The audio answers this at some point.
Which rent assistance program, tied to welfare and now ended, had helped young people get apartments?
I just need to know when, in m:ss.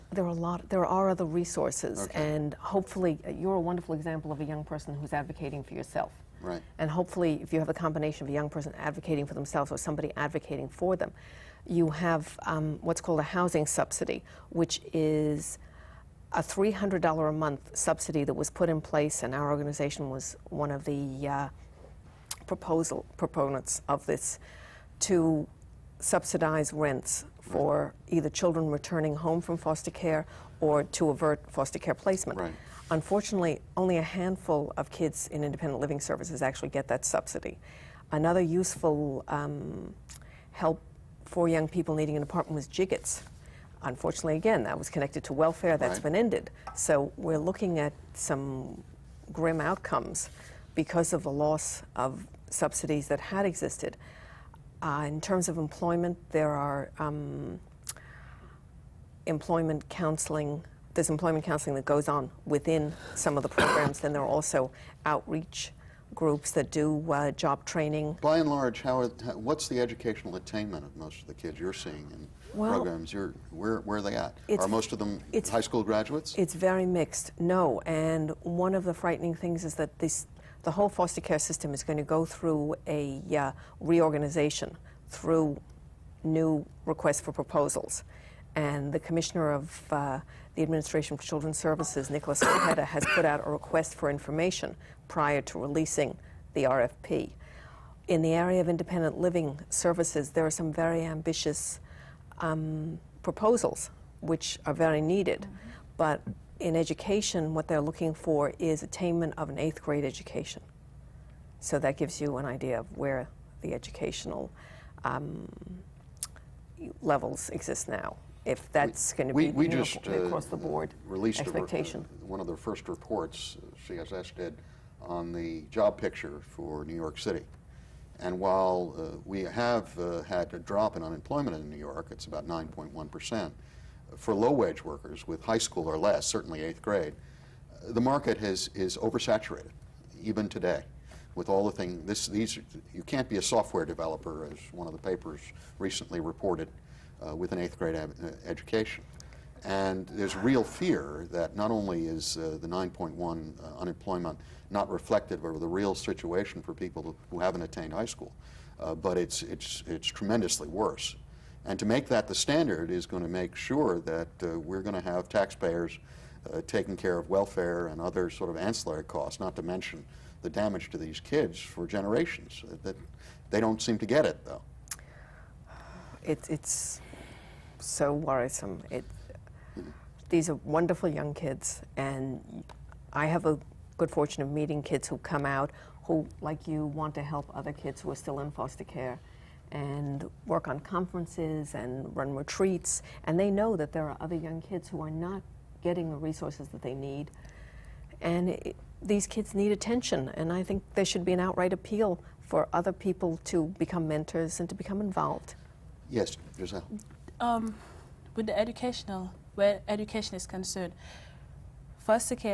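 0:42.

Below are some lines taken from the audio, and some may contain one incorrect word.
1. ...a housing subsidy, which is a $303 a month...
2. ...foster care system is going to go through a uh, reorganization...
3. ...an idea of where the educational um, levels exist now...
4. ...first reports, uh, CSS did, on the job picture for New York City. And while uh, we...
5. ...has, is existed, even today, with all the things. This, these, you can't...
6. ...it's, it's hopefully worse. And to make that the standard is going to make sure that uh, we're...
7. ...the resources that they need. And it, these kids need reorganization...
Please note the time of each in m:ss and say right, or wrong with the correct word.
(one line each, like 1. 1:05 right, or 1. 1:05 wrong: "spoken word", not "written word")
1. 0:13 wrong: "300", not "303"
2. 1:20 right
3. 1:52 right
4. 2:02 right
5. 2:18 wrong: "oversaturated", not "existed"
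6. 2:39 wrong: "tremendously", not "hopefully"
7. 3:16 wrong: "attention", not "reorganization".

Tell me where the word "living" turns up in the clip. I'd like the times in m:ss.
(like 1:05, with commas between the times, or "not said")
0:35, 1:39.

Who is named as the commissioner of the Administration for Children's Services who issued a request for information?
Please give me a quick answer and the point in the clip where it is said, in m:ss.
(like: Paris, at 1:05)
Nicholas Ojeda, at 1:32.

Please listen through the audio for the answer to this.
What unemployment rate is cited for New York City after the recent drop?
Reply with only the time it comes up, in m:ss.
2:12.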